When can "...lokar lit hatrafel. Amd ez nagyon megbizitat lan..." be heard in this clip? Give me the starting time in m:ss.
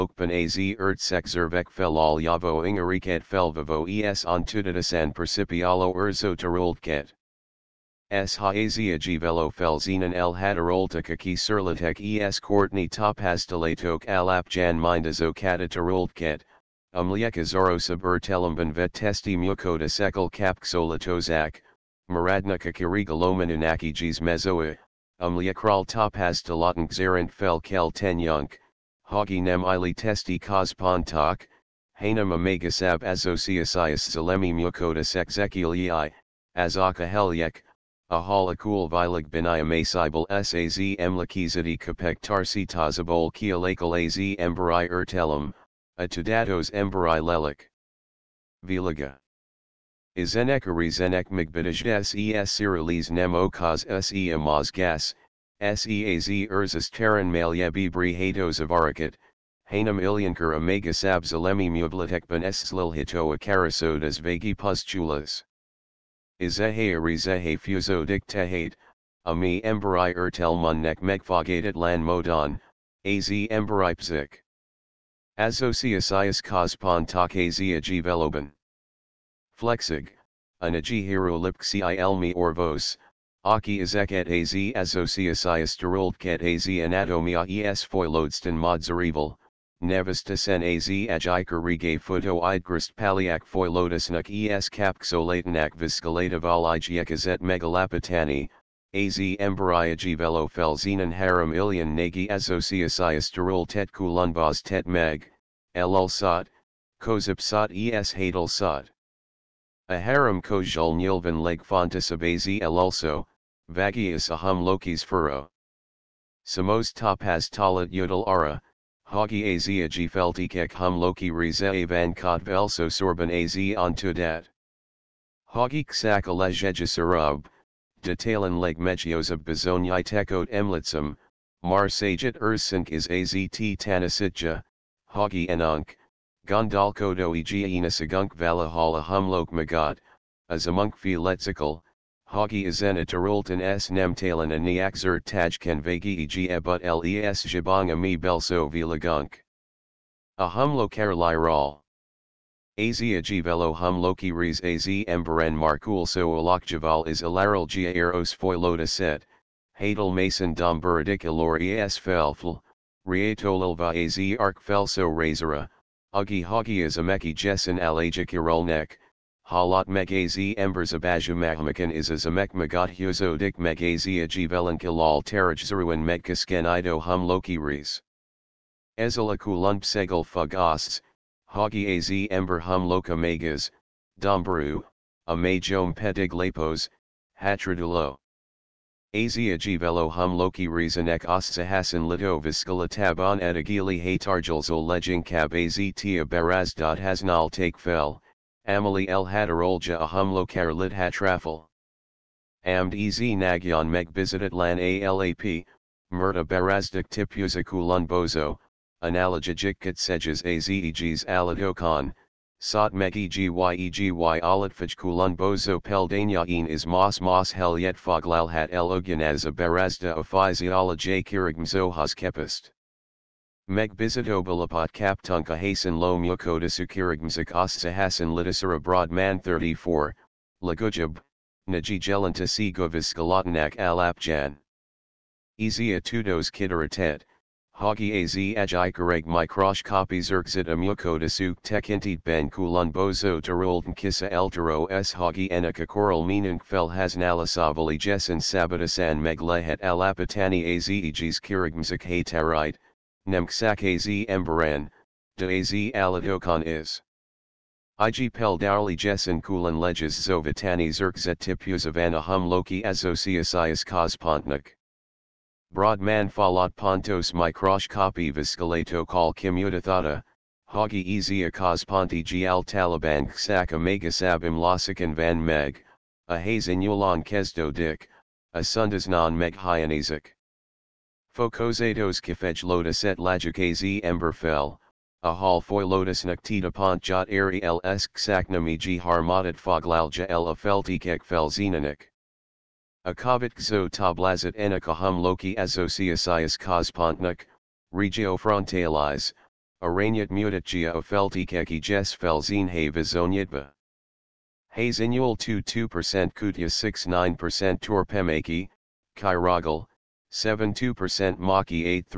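3:20.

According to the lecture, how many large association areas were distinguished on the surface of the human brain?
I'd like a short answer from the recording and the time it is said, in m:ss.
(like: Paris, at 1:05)
3, at 1:41.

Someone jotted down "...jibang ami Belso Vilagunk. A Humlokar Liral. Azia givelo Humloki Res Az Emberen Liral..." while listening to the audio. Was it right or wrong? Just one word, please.
wrong.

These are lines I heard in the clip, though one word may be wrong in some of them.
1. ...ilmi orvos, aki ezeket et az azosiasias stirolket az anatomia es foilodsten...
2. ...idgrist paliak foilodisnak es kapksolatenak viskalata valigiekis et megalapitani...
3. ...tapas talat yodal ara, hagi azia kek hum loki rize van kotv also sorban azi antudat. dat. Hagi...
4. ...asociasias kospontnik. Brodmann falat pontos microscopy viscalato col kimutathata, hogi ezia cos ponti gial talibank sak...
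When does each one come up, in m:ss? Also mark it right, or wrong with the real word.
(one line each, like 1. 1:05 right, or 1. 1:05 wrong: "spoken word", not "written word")
1. 1:21 right
2. 1:32 right
3. 1:56 right
4. 4:22 right.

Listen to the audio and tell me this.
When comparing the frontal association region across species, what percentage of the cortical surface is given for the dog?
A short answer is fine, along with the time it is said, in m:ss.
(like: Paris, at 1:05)
9 percent, at 5:07.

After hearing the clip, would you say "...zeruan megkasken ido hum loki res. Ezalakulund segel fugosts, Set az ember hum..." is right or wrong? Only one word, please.
wrong.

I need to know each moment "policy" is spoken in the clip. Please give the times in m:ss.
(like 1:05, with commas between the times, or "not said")
not said.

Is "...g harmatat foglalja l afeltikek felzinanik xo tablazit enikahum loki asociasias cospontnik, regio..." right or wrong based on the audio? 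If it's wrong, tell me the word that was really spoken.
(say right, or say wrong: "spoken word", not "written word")
right.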